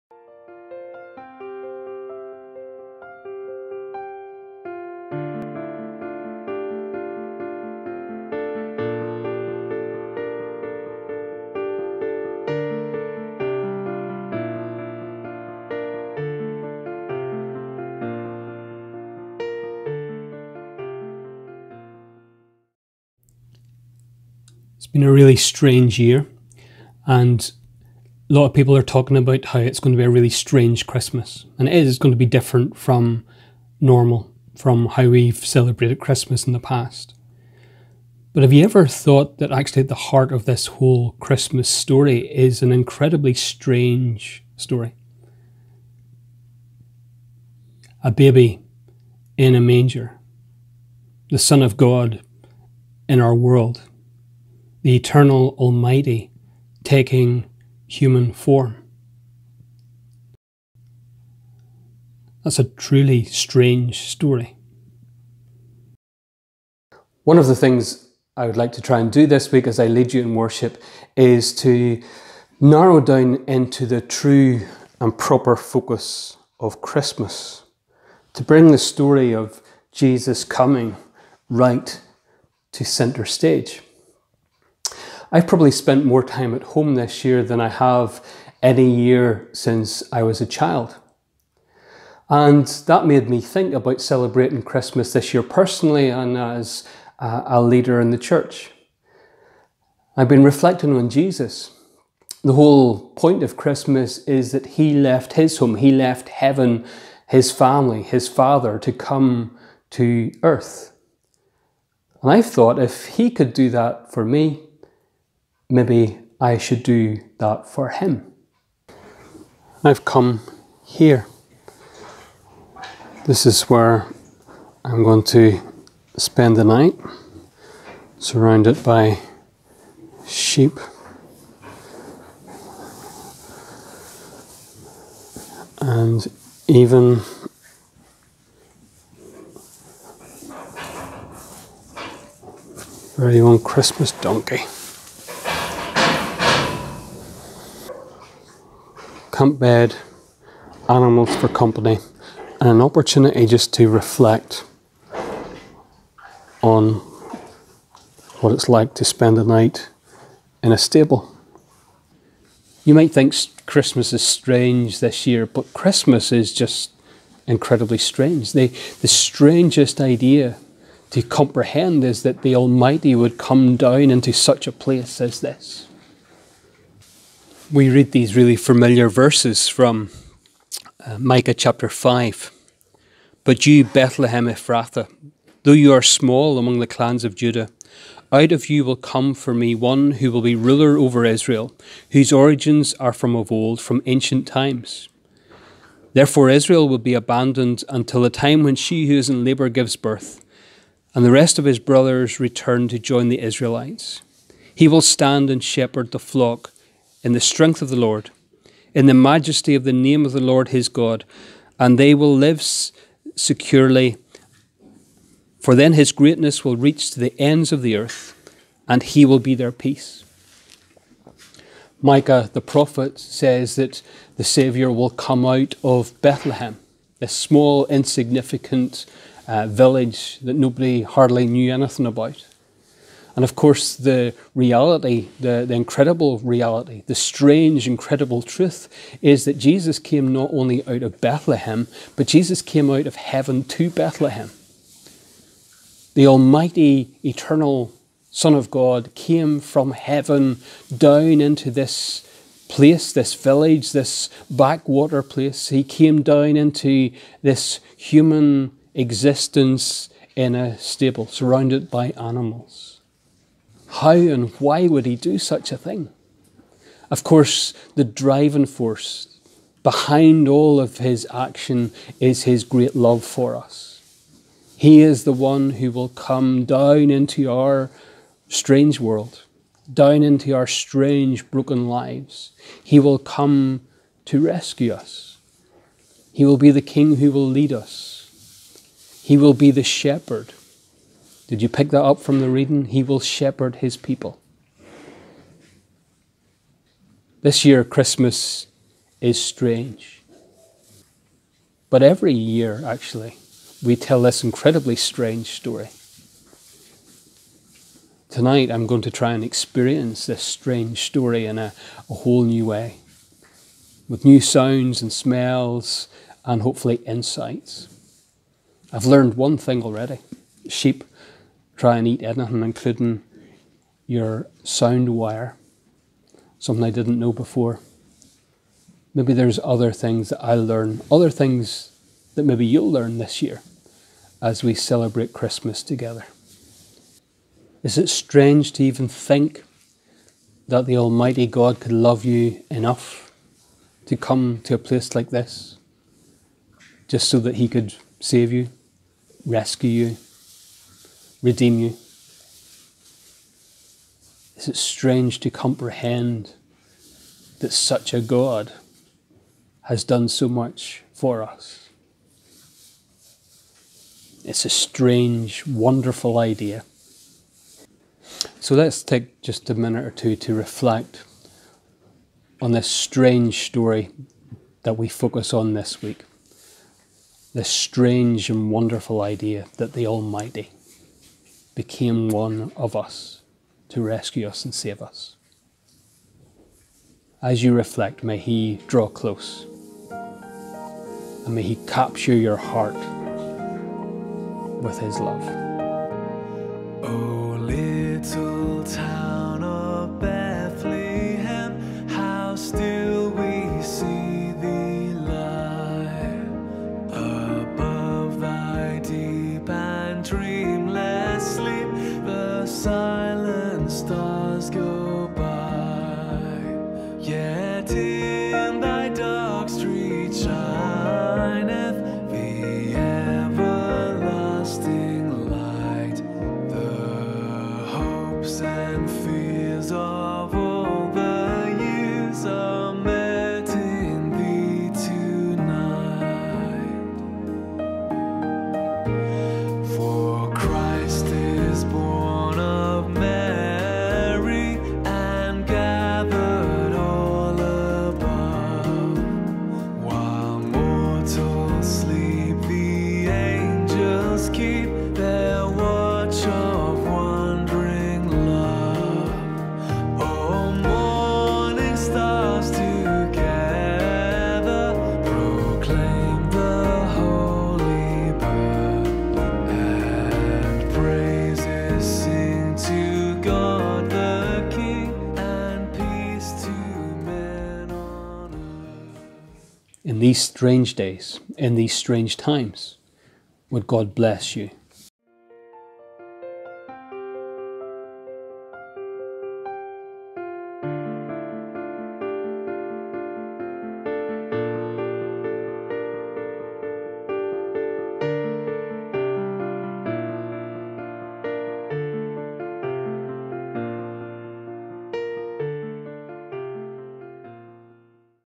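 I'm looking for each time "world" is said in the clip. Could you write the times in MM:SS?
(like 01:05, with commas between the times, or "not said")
00:53, 04:39.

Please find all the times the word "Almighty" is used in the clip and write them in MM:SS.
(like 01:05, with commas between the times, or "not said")
00:55, 02:52, 04:06, 05:40, 06:20.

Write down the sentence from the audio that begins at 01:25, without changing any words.
I've probably spent more time at home this year than I have any year since I was a child.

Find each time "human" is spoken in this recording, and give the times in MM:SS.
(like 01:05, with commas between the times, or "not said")
00:57, 04:17.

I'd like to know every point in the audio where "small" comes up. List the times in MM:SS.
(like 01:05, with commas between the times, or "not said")
03:06, 03:47.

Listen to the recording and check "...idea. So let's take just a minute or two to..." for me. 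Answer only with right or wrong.
right.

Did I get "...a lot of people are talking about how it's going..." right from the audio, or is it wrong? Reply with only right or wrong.
right.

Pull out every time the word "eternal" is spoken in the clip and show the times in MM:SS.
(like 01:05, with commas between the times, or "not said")
00:54, 04:07.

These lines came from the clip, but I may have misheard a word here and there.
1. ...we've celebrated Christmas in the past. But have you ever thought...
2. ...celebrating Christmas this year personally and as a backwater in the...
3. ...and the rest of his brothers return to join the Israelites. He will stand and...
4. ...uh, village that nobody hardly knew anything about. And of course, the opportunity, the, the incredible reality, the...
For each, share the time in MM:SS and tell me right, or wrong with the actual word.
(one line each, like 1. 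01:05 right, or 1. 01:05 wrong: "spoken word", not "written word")
1. 00:35 right
2. 01:34 wrong: "leader", not "backwater"
3. 03:21 right
4. 03:49 wrong: "reality", not "opportunity".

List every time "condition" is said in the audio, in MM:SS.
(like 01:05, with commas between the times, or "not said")
not said.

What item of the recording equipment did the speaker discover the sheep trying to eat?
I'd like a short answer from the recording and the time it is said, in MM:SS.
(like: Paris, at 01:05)
sound wire, at 05:24.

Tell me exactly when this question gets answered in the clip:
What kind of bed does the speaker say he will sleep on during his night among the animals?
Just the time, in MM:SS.
02:29.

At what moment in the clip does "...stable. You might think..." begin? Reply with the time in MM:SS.
02:40.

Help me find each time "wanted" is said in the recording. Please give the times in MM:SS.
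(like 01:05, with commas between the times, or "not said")
not said.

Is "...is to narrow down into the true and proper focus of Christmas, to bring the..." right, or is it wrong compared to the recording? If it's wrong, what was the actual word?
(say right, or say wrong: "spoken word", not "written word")
right.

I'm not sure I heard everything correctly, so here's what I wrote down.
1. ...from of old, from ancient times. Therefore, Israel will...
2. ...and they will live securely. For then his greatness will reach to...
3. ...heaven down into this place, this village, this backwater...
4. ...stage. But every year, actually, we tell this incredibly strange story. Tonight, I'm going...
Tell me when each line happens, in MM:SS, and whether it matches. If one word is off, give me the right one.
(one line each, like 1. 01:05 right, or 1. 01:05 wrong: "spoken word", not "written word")
1. 03:13 right
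2. 03:31 right
3. 04:09 right
4. 04:59 wrong: "strange", not "stage".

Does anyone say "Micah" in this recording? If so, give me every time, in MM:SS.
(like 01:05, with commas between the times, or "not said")
03:01, 03:42.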